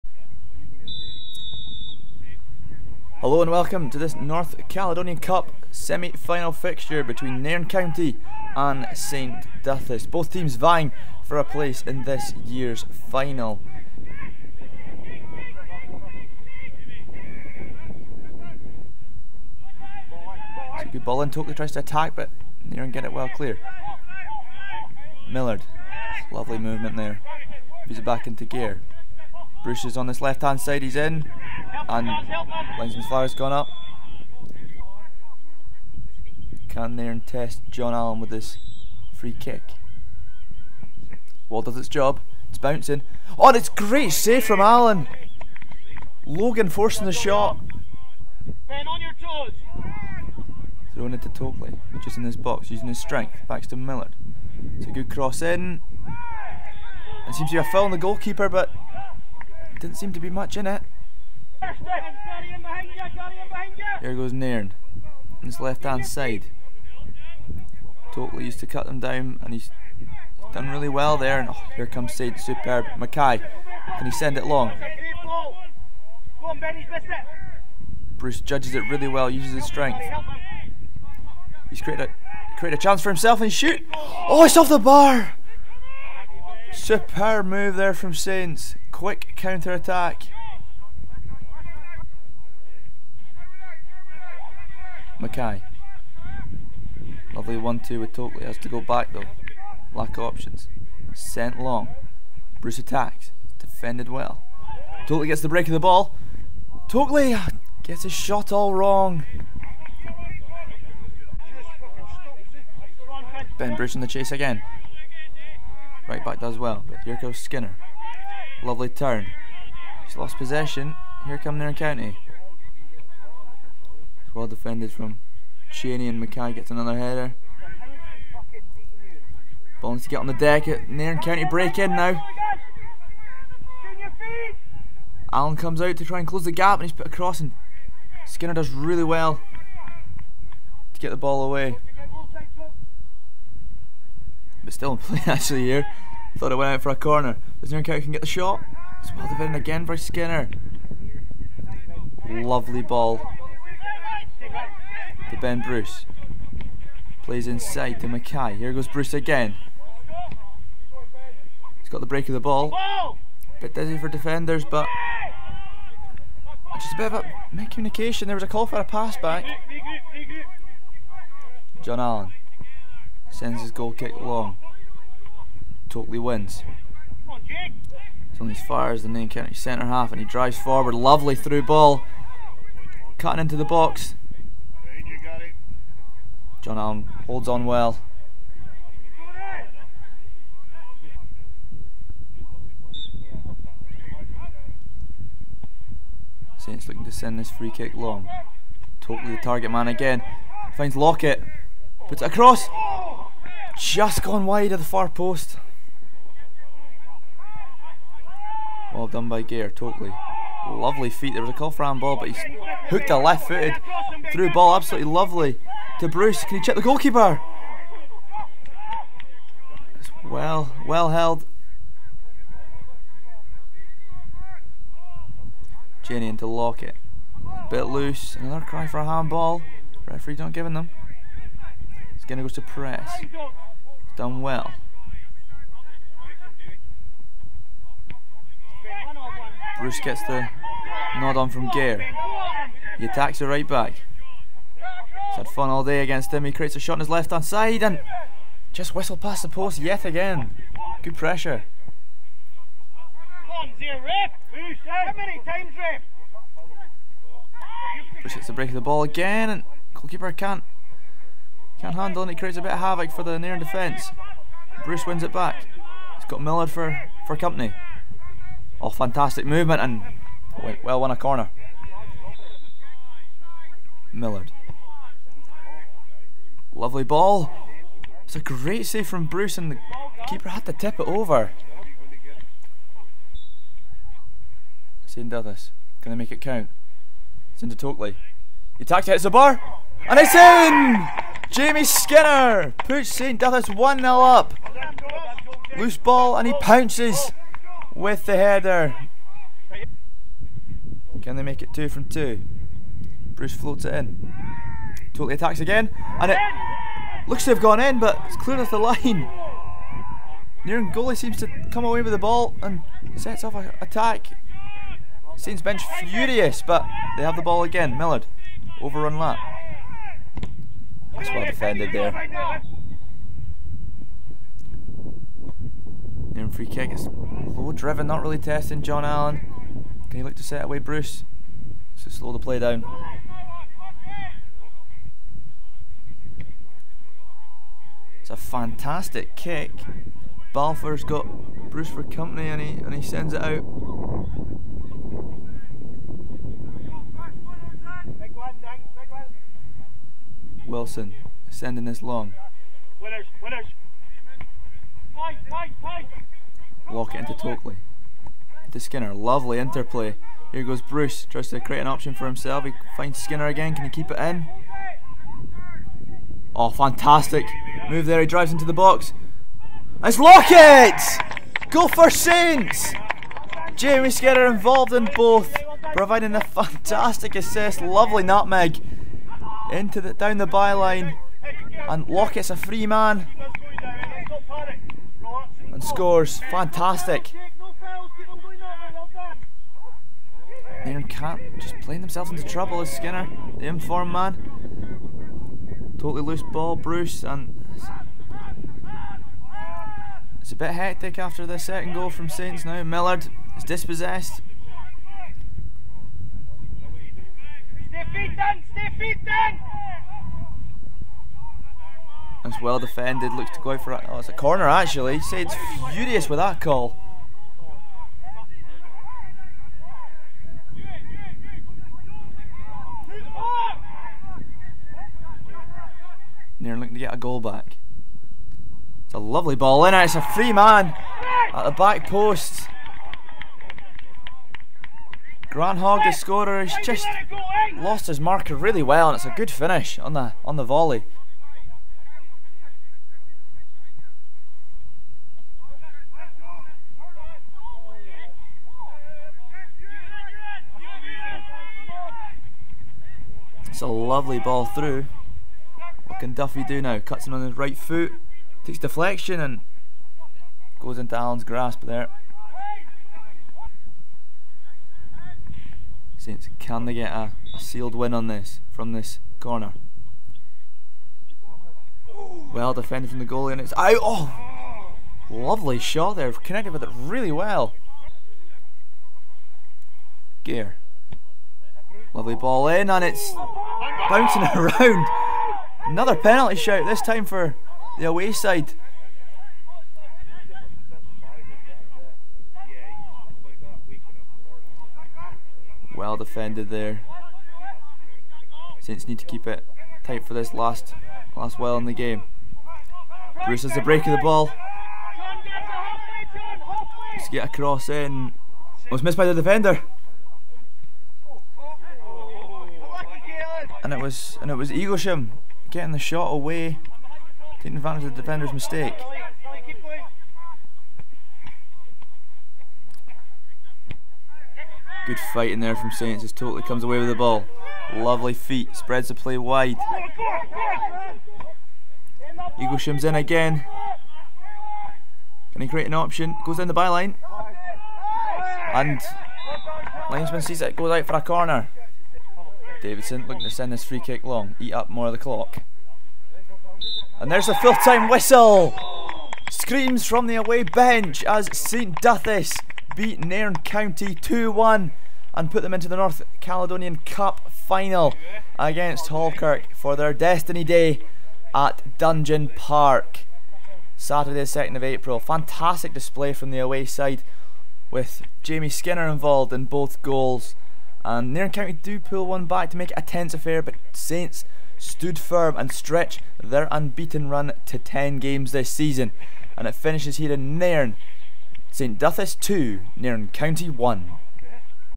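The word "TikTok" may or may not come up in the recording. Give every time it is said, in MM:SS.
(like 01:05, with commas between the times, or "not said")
not said.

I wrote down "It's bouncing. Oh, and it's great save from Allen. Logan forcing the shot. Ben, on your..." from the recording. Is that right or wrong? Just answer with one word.
right.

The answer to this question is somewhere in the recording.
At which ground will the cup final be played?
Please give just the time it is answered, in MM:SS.
09:21.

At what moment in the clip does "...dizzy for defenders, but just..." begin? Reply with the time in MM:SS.
02:43.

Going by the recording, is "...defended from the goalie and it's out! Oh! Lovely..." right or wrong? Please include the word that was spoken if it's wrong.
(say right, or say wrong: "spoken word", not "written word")
right.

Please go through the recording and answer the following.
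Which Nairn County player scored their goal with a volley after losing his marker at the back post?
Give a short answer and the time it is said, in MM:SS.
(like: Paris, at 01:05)
Grant Hogg, at 07:15.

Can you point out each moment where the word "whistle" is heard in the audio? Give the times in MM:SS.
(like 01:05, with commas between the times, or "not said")
04:08, 09:08.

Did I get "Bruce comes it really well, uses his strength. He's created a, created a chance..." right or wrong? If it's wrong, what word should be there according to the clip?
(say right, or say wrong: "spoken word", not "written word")
wrong: "judges", not "comes".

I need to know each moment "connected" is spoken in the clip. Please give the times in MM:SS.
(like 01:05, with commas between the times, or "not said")
07:56.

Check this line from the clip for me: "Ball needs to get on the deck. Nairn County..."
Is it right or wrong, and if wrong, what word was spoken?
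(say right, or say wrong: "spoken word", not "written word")
right.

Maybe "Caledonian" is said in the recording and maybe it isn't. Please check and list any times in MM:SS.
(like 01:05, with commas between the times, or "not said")
00:04, 09:16.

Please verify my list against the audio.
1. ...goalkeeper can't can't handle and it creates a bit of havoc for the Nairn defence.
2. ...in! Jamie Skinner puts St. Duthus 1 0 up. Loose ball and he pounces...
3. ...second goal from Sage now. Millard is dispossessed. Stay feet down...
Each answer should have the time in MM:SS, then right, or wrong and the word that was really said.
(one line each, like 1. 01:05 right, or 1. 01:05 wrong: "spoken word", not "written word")
1. 04:19 right
2. 04:50 right
3. 06:41 wrong: "Saints", not "Sage".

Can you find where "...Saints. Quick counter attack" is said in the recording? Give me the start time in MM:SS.
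01:28.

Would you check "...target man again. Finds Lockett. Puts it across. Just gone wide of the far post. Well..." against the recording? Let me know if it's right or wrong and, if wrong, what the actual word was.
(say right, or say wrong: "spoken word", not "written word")
right.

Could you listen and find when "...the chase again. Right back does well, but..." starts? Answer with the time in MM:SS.
01:54.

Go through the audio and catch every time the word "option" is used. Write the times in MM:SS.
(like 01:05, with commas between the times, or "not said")
01:40, 06:01, 08:55.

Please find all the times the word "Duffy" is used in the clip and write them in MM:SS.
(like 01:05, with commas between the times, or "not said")
07:36.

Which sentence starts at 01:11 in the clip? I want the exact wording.
And oh, here comes Sage, superb.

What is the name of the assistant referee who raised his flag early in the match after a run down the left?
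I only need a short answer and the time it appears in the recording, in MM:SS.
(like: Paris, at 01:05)
Flowers, at 00:33.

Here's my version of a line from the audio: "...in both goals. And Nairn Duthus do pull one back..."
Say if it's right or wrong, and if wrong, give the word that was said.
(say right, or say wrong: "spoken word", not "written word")
wrong: "County", not "Duthus".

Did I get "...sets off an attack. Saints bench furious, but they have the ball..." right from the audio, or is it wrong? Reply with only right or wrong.
right.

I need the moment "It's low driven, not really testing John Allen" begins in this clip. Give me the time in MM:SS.
05:26.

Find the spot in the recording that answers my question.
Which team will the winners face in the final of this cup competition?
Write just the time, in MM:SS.
09:19.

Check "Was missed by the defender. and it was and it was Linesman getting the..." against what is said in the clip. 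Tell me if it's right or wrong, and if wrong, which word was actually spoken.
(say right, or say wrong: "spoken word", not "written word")
wrong: "Eaglesham", not "Linesman".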